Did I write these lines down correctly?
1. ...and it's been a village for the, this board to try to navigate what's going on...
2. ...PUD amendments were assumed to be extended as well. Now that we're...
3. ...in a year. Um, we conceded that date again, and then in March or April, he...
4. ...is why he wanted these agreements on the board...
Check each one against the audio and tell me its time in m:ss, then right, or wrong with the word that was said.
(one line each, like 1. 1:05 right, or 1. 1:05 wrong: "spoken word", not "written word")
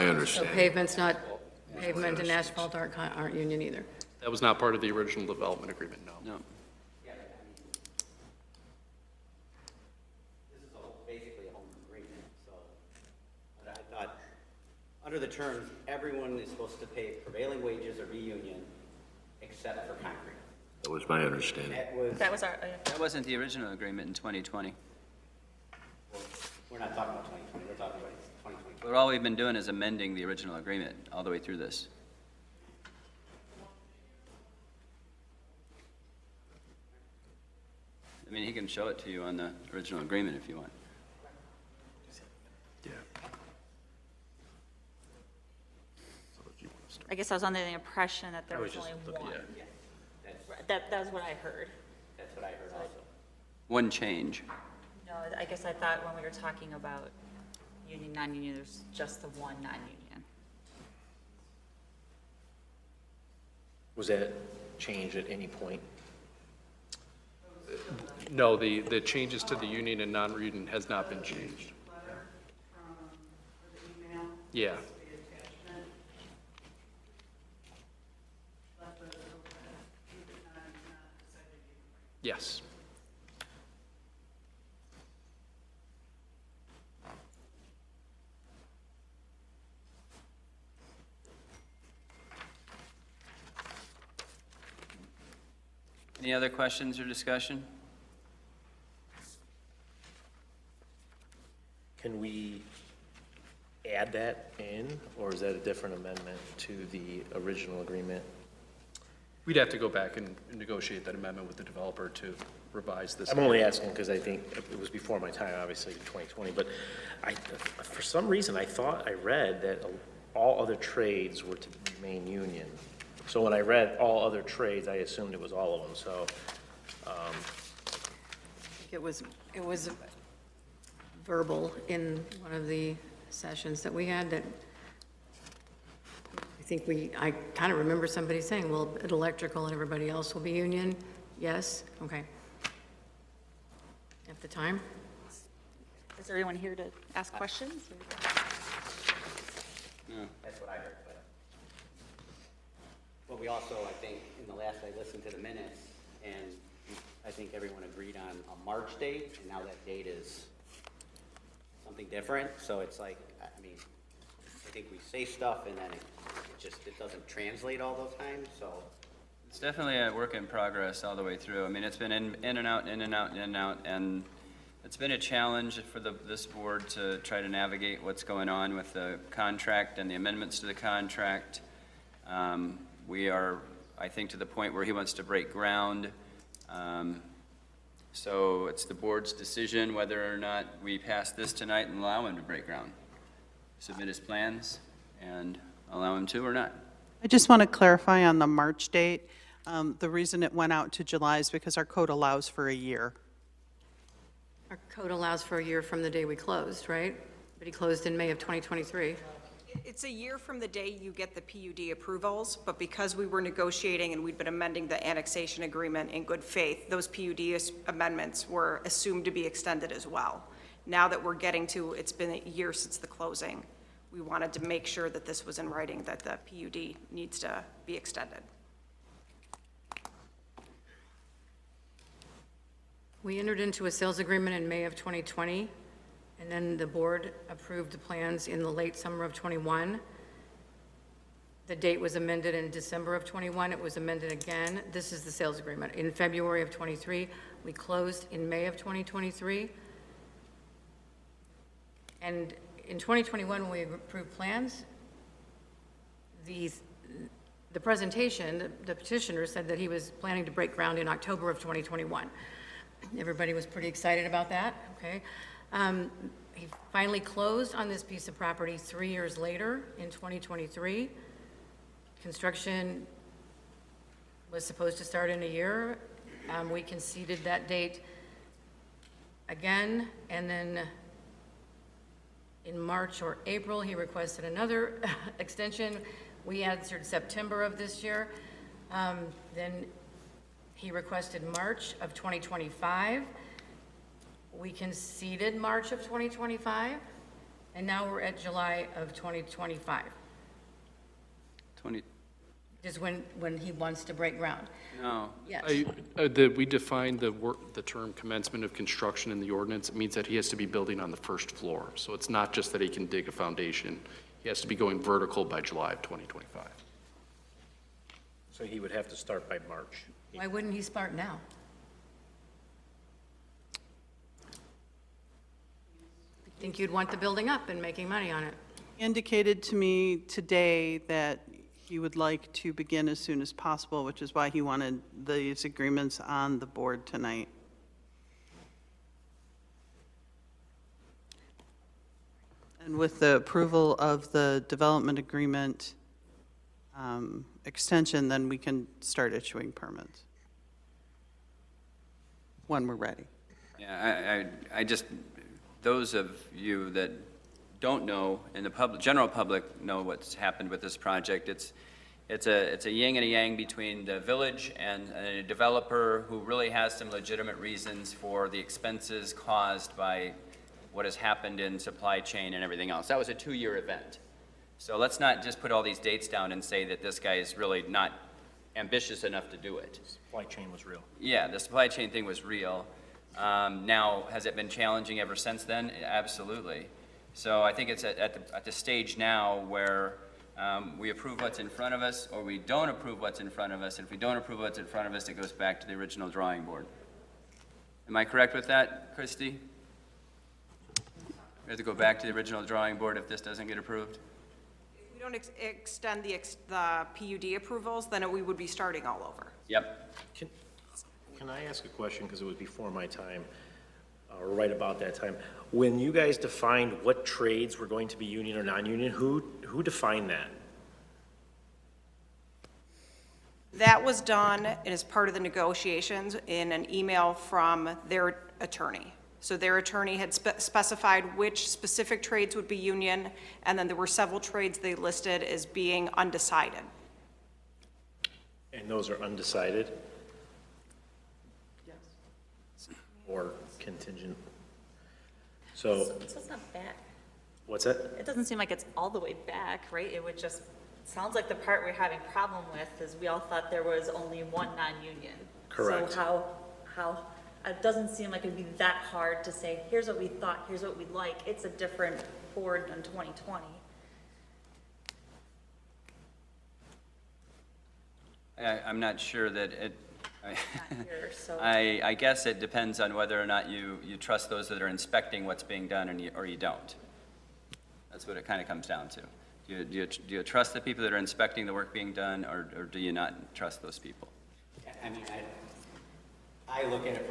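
1. 2:53 wrong: "challenge", not "village"
2. 3:37 right
3. 4:35 right
4. 5:34 right.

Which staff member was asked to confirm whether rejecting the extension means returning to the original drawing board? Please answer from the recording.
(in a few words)
Christy.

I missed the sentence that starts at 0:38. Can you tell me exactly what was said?
I mean, he can show it to you on the original agreement if you want.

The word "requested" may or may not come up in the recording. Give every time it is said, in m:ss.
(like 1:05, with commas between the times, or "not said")
4:43, 4:50.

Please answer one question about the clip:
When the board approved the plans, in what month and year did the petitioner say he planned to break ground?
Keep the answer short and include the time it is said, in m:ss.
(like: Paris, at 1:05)
October 2021, at 4:21.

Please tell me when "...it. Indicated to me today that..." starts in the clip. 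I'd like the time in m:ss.
5:28.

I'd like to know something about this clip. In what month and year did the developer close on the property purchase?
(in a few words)
May 2023.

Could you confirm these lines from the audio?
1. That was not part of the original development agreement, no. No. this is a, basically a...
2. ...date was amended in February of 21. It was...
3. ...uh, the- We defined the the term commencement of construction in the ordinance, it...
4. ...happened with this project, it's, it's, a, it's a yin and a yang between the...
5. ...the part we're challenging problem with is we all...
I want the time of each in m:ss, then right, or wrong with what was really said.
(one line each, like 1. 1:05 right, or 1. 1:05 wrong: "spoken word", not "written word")
1. 0:04 right
2. 4:01 wrong: "December", not "February"
3. 5:06 right
4. 6:00 right
5. 7:31 wrong: "having", not "challenging".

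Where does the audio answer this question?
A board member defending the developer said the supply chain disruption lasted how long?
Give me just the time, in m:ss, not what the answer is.
6:13.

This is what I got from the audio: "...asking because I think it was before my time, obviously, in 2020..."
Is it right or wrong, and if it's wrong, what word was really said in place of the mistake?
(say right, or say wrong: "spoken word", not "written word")
right.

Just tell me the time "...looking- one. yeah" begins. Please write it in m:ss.
0:49.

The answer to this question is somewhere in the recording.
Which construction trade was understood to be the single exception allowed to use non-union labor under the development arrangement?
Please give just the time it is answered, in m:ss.
0:19.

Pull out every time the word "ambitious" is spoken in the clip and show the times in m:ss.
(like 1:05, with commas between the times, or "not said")
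6:18.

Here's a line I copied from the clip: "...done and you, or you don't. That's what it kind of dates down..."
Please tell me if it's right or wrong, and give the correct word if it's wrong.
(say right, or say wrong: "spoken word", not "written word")
wrong: "comes", not "dates".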